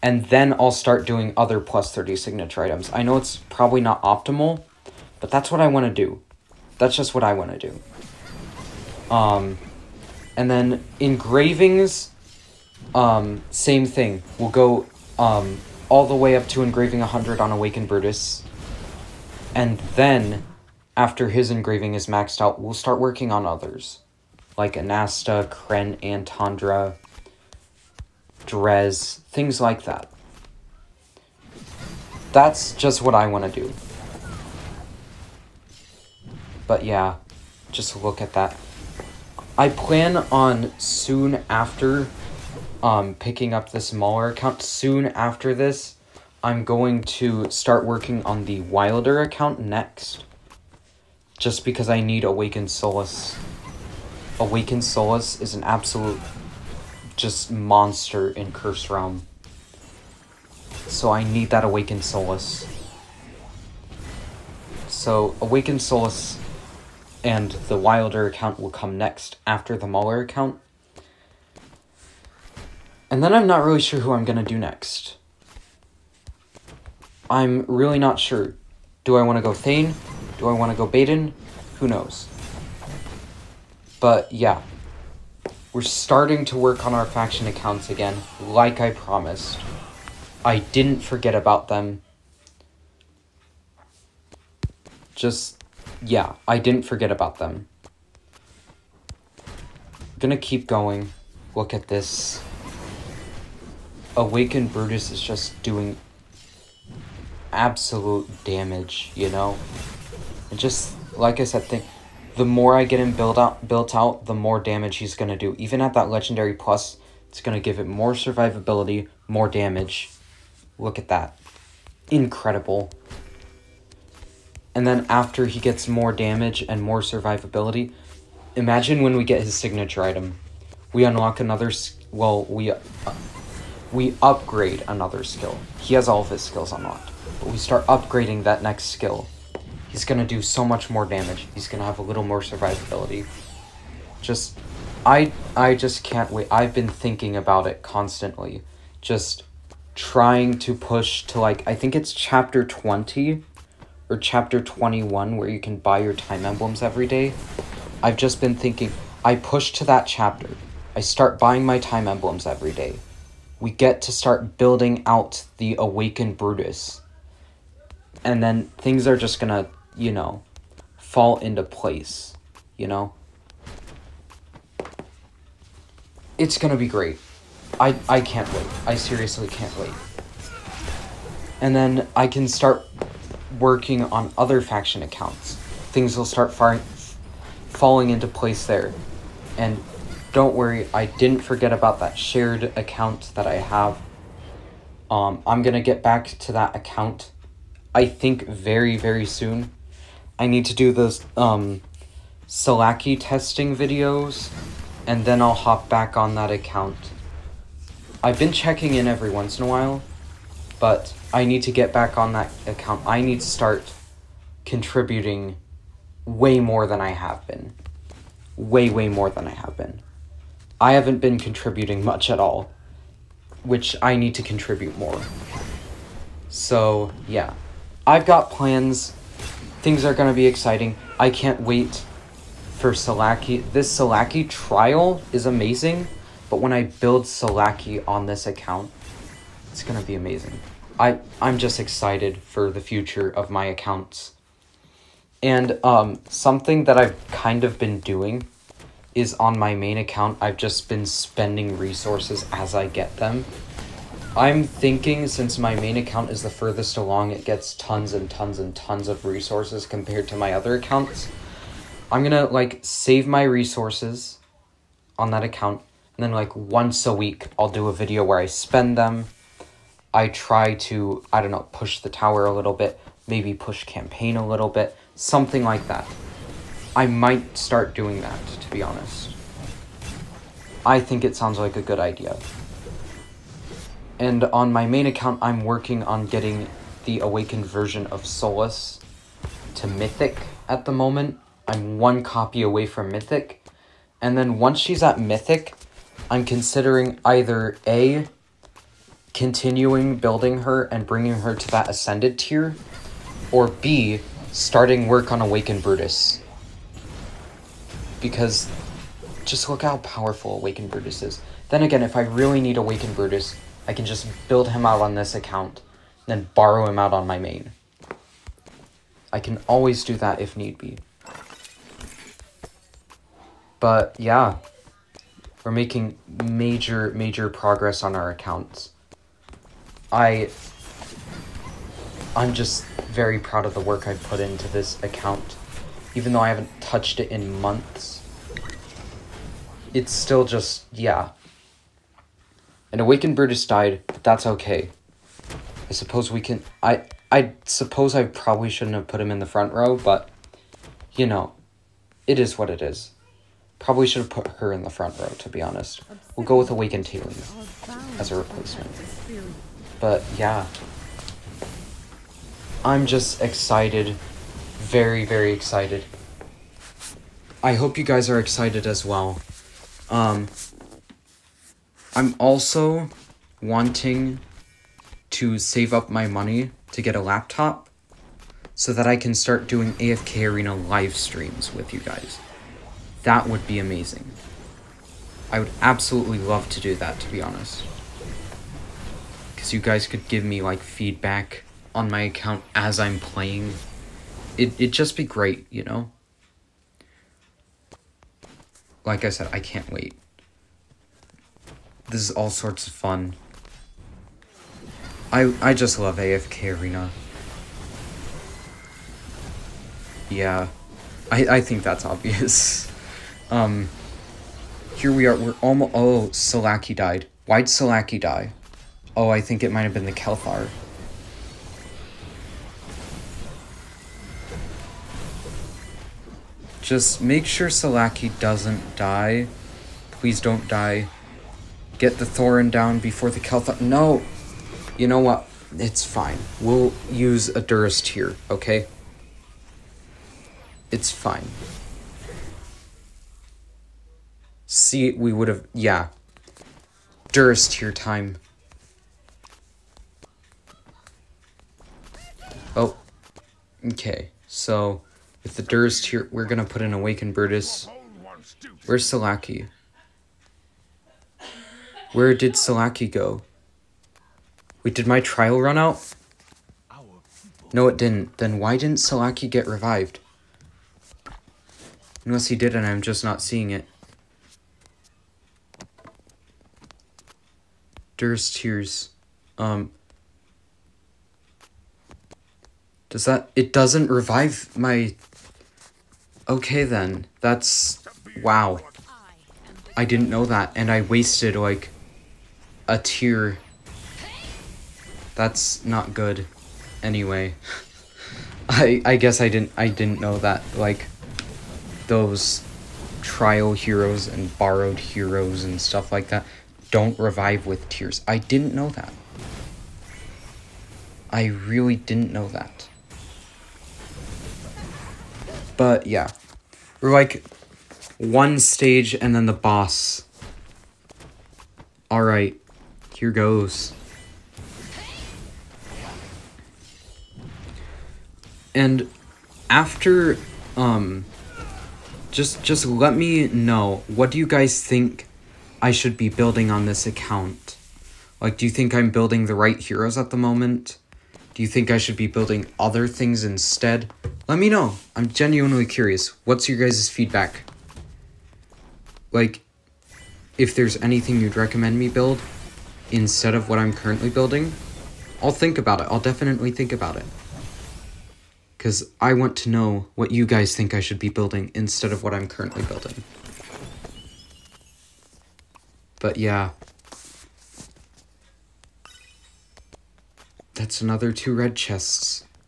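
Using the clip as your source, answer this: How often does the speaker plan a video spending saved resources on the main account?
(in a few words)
once a week.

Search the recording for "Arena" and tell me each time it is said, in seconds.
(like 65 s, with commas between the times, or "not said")
380 s, 406 s.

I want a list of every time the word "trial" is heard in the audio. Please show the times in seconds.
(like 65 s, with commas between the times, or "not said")
234 s, 465 s, 503 s.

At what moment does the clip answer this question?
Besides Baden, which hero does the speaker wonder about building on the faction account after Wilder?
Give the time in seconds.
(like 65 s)
79 s.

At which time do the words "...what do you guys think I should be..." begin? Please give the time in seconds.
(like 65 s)
534 s.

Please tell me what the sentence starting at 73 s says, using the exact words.
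And then I'm not really sure who I'm going to do next.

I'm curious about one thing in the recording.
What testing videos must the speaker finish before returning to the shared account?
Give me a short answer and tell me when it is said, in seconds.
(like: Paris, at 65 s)
Salaki testing videos, at 202 s.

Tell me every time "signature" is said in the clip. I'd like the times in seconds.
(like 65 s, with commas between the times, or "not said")
2 s, 129 s.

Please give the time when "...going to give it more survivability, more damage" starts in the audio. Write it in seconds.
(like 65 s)
117 s.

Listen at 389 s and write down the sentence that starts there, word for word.
Because you guys could give me, like, feedback on my account as I'm playing.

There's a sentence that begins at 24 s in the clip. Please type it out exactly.
Like Anasta, Kren, and Antandra, Drez, things like that.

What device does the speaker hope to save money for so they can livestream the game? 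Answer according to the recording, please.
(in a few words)
a laptop.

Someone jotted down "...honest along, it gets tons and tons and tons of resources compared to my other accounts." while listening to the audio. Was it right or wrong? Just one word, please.
wrong.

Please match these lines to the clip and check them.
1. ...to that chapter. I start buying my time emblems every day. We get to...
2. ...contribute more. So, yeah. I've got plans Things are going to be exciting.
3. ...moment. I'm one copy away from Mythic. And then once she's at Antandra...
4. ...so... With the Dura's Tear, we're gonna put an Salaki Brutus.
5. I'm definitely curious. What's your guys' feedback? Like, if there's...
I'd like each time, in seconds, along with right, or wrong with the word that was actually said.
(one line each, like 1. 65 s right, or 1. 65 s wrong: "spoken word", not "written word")
1. 159 s right
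2. 224 s right
3. 290 s wrong: "Mythic", not "Antandra"
4. 454 s wrong: "Awakened", not "Salaki"
5. 545 s wrong: "genuinely", not "definitely".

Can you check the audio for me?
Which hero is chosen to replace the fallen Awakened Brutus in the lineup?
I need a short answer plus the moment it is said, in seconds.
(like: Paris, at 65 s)
Awakened Taylor, at 356 s.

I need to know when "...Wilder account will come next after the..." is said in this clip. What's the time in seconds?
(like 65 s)
67 s.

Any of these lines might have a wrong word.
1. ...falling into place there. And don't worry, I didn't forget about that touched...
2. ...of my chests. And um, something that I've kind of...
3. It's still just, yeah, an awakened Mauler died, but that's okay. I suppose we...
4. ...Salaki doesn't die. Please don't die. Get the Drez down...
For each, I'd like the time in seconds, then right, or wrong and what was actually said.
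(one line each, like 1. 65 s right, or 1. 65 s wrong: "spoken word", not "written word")
1. 187 s wrong: "shared", not "touched"
2. 243 s wrong: "accounts", not "chests"
3. 339 s wrong: "Brutus", not "Mauler"
4. 427 s wrong: "Thoran", not "Drez".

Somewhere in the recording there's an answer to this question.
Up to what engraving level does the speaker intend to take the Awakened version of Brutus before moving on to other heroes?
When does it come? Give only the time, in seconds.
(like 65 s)
16 s.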